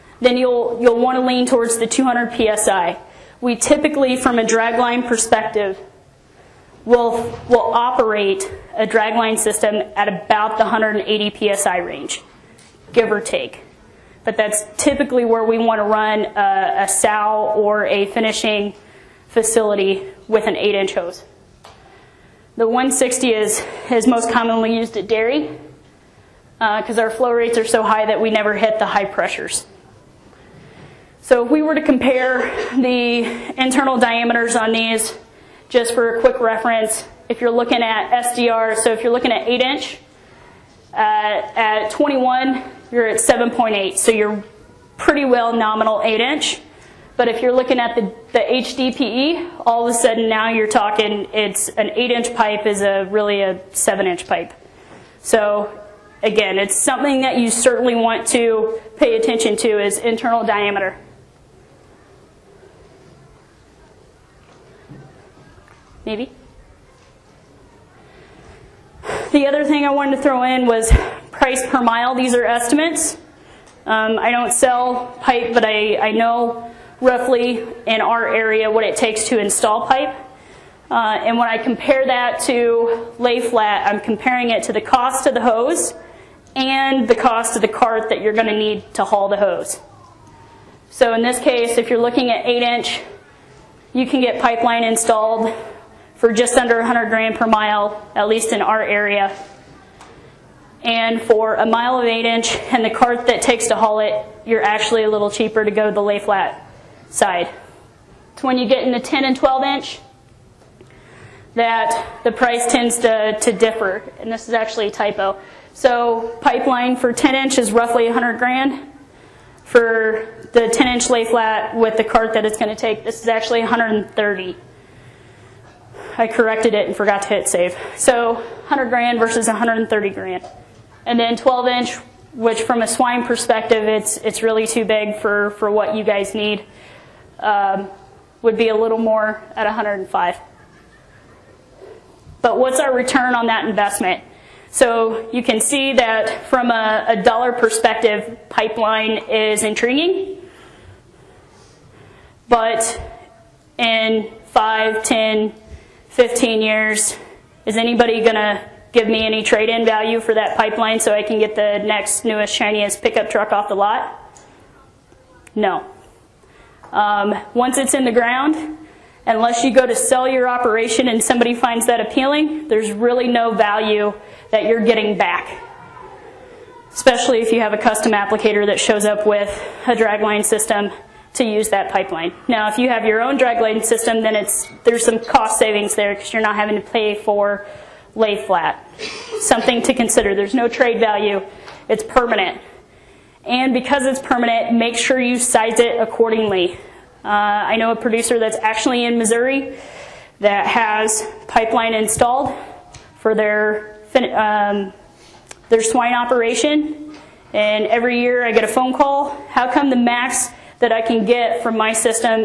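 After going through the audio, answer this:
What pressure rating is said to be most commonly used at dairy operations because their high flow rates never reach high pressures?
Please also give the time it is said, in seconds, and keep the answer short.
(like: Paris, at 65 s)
160, at 22 s.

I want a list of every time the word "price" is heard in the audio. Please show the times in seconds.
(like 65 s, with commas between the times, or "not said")
71 s, 112 s.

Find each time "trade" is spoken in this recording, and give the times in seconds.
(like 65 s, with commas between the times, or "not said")
159 s, 190 s.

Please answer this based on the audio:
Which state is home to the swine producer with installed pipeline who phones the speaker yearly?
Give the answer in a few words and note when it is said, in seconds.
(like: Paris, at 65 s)
Missouri, at 199 s.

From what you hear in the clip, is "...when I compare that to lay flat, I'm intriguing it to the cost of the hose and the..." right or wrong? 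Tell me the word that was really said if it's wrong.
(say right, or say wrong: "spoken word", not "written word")
wrong: "comparing", not "intriguing".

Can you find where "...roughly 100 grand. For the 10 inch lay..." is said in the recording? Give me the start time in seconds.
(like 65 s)
117 s.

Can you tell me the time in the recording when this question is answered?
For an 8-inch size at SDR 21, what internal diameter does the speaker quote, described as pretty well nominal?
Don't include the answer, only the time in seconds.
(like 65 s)
43 s.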